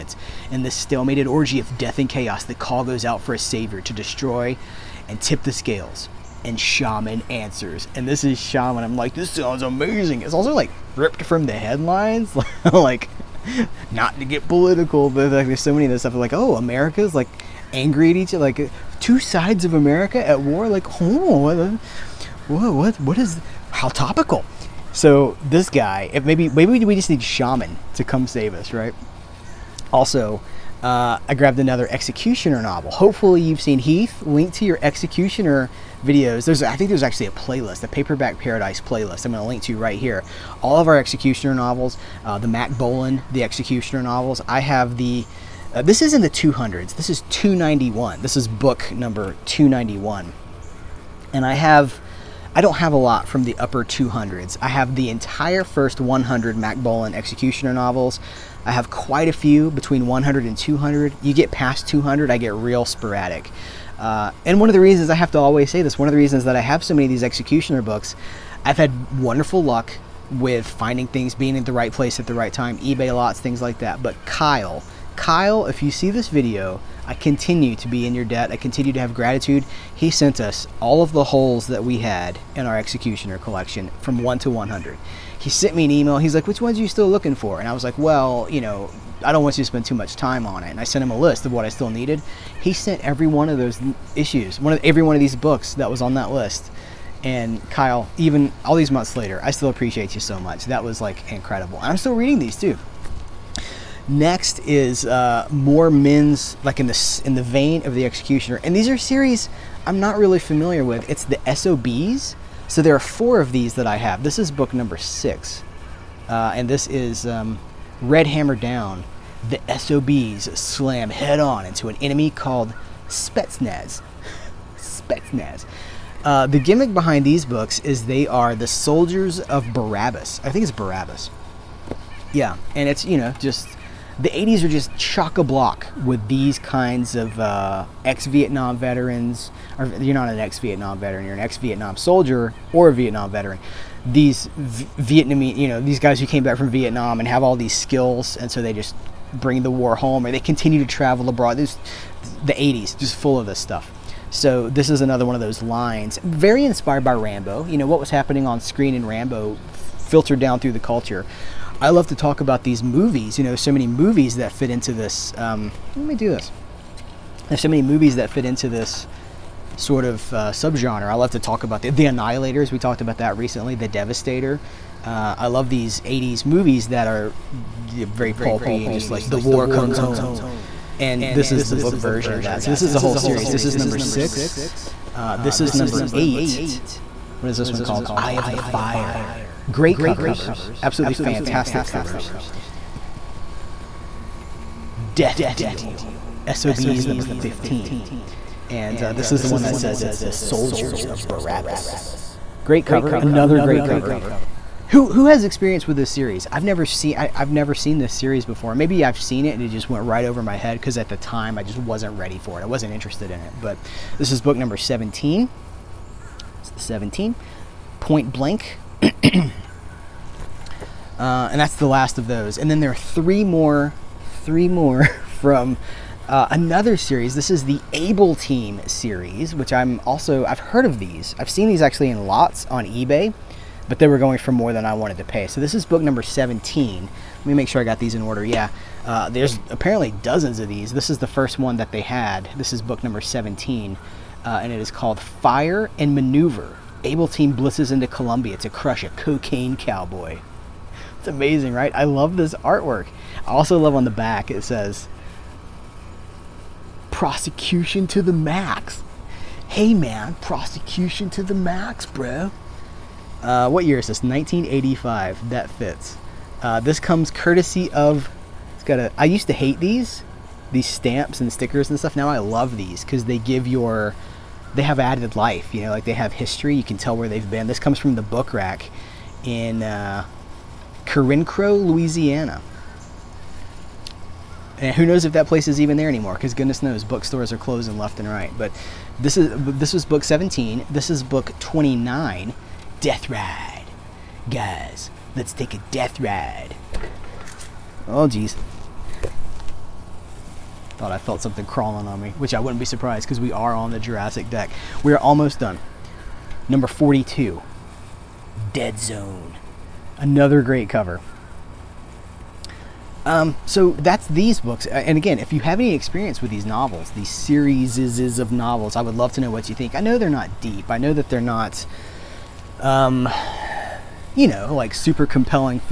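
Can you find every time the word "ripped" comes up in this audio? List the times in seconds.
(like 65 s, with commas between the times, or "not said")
10 s.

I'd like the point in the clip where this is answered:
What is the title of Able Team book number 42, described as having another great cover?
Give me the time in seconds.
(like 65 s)
308 s.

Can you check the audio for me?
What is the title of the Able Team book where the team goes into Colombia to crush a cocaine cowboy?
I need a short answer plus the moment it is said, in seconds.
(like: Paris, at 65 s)
Fire and Maneuver, at 245 s.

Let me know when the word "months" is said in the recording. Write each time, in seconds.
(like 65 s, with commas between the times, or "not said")
98 s.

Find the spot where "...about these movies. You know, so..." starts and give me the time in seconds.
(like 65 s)
162 s.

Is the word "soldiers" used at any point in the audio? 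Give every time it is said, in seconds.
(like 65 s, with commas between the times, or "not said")
128 s, 141 s, 200 s.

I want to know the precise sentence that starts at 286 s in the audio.
Because goodness knows, bookstores are closing left and right.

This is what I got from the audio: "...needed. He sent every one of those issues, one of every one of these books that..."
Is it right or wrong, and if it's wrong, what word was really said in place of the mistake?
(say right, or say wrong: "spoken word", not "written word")
right.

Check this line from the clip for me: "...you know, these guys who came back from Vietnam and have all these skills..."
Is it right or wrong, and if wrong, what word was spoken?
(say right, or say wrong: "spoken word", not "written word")
right.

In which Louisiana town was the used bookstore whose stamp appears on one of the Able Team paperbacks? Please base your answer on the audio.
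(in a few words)
Carencro.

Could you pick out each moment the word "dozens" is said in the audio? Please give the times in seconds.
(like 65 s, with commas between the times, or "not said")
240 s.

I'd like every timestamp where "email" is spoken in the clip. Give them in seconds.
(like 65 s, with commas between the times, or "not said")
85 s.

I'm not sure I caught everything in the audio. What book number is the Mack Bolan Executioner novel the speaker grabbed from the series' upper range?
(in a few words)
291.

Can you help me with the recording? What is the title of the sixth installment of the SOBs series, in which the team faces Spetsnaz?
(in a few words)
Red Hammer Down.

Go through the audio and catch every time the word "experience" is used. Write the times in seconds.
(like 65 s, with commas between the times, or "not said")
205 s, 315 s.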